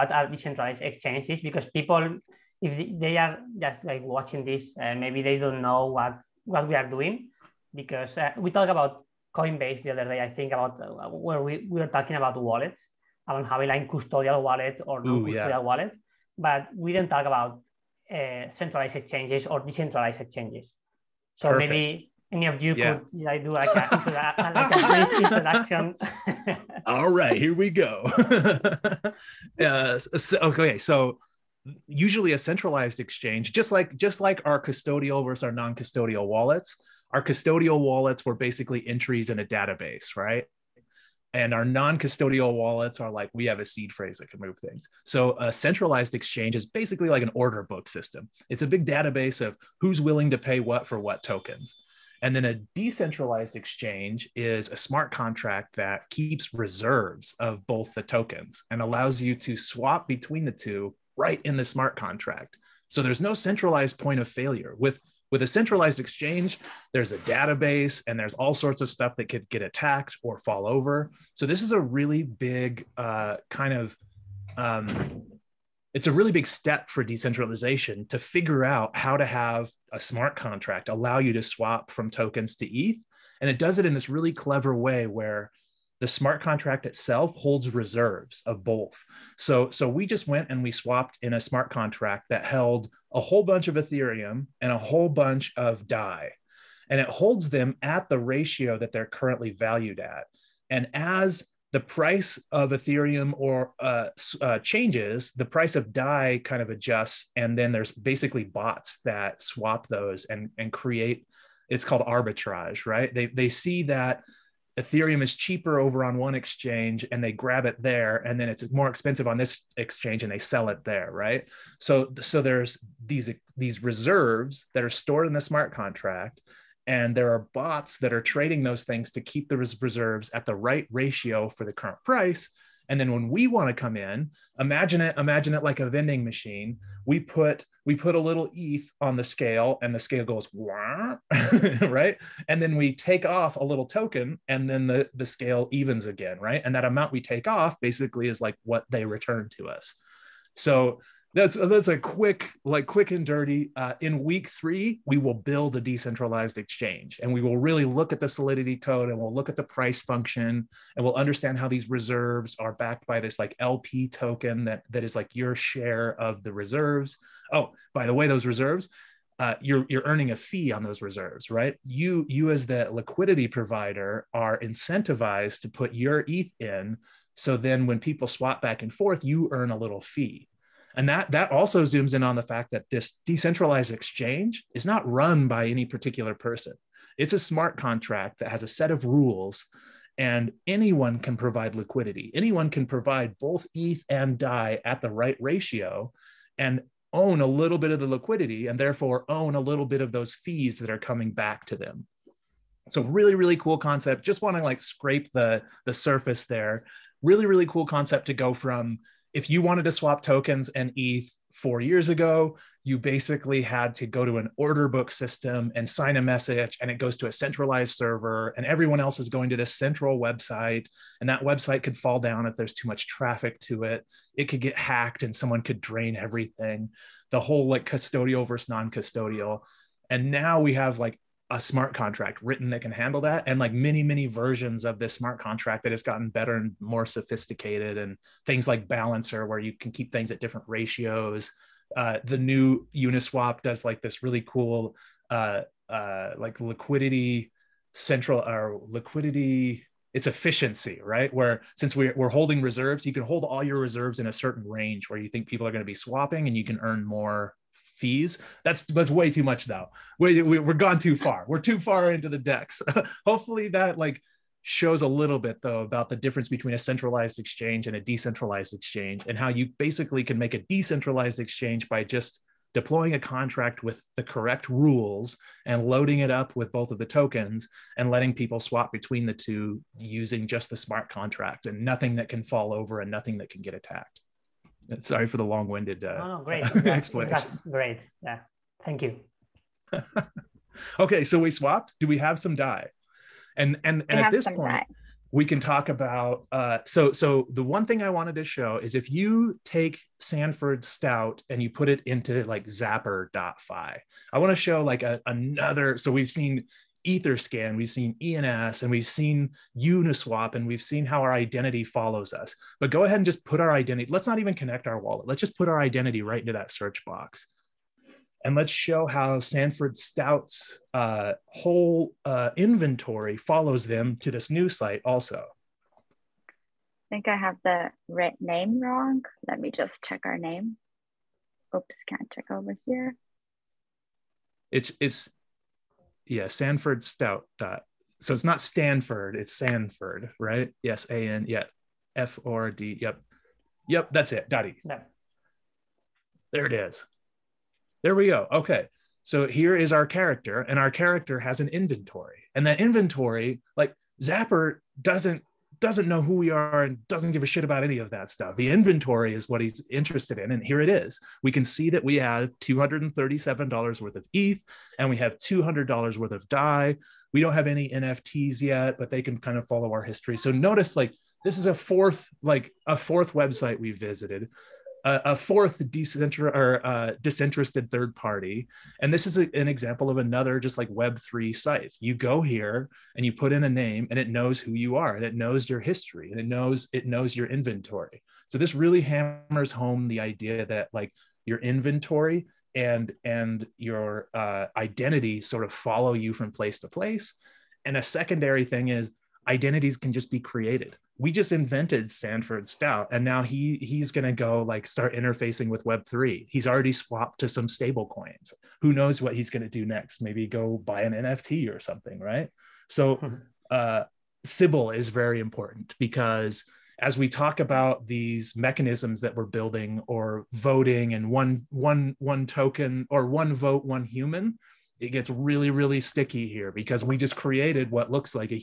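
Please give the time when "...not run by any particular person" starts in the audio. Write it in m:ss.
3:04.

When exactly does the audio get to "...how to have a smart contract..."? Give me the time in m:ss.
1:18.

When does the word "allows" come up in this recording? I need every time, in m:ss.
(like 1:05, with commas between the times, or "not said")
0:58, 1:20.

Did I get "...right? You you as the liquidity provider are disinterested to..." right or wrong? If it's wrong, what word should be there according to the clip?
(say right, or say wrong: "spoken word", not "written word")
wrong: "incentivized", not "disinterested".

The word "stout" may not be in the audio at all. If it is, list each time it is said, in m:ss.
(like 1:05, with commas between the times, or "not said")
5:00, 5:19, 5:37, 6:42.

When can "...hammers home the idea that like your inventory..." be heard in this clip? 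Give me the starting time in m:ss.
6:29.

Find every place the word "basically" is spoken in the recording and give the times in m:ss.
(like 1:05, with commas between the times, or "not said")
0:38, 0:46, 1:47, 2:27, 3:32, 4:29.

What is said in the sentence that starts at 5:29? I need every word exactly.
Let me just check our name.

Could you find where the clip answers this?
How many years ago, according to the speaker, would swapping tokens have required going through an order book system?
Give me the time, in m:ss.
3:31.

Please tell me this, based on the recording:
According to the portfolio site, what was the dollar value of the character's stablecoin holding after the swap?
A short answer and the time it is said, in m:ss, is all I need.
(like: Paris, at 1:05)
$200, at 6:05.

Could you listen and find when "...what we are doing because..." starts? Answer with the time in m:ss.
0:06.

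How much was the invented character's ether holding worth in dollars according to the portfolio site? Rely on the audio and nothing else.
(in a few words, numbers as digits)
$237.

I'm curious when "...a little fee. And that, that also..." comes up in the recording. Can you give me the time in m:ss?
2:59.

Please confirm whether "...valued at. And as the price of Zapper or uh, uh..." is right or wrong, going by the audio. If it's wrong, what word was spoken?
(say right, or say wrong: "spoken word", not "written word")
wrong: "Ethereum", not "Zapper".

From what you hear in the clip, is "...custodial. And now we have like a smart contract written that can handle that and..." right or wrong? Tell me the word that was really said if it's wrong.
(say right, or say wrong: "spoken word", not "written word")
right.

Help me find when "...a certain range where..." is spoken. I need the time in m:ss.
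4:14.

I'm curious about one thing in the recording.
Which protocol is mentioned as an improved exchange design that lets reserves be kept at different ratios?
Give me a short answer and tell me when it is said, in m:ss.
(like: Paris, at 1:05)
Balancer, at 3:58.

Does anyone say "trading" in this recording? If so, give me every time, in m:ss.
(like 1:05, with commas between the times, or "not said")
2:08.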